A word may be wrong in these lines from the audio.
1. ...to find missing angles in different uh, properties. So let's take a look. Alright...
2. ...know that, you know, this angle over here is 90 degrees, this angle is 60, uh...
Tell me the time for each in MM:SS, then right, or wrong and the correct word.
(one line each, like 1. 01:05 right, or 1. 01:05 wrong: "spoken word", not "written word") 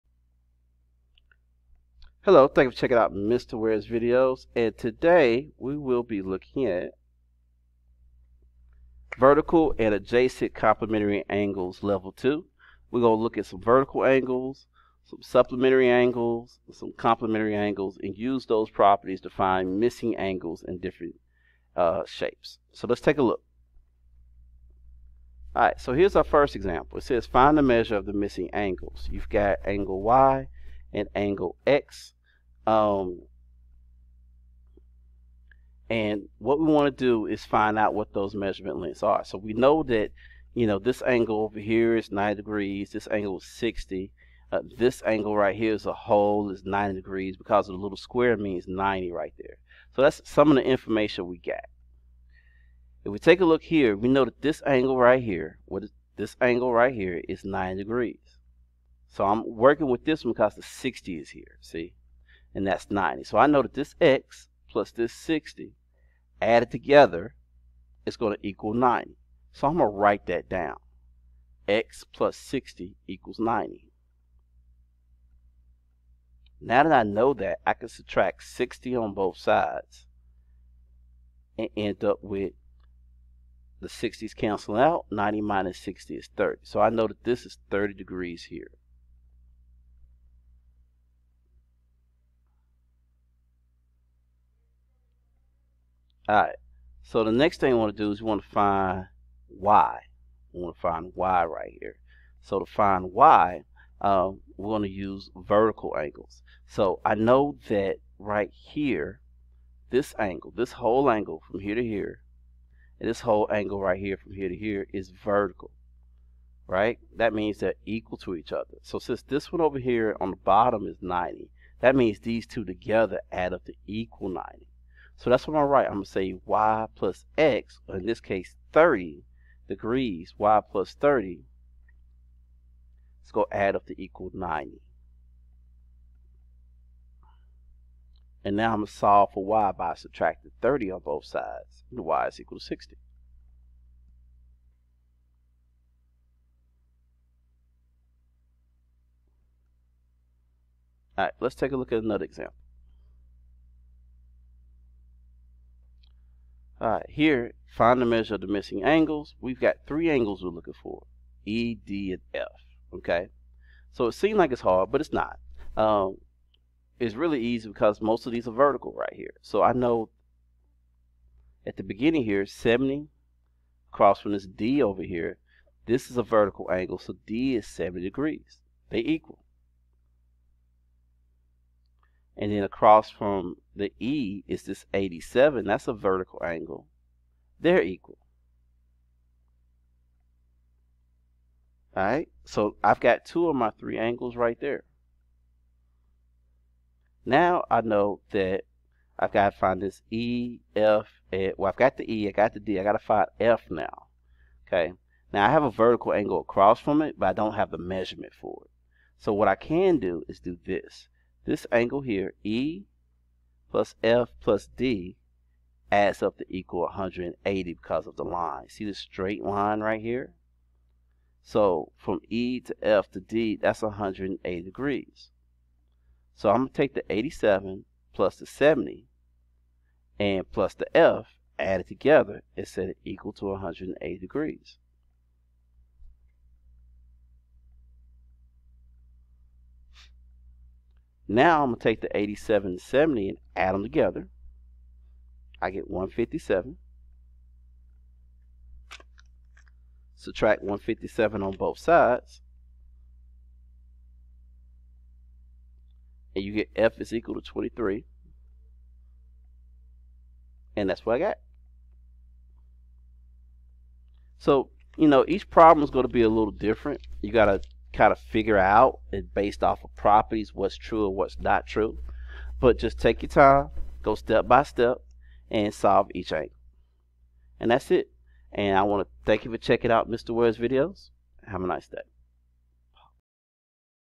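1. 00:19 wrong: "shapes", not "properties"
2. 00:39 right.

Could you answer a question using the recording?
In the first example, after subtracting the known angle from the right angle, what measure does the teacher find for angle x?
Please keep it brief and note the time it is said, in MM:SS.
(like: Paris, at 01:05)
30, at 01:25.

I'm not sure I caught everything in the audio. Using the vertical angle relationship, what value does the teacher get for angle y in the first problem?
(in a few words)
60.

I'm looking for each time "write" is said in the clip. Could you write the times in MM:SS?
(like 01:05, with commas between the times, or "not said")
01:09, 02:05.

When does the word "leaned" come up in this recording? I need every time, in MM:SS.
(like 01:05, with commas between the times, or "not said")
not said.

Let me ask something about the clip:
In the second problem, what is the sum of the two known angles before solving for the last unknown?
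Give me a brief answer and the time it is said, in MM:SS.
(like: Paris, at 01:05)
157, at 04:05.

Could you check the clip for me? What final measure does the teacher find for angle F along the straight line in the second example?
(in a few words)
23.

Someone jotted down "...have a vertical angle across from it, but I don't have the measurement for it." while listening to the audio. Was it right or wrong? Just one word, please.
right.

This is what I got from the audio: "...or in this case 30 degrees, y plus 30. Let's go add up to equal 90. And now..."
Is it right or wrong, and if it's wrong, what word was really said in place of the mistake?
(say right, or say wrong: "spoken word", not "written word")
right.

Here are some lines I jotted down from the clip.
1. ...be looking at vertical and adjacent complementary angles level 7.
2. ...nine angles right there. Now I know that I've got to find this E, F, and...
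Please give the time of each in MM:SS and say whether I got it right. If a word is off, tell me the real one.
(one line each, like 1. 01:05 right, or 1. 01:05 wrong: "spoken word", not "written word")
1. 00:06 wrong: "2", not "7"
2. 03:13 wrong: "three", not "nine".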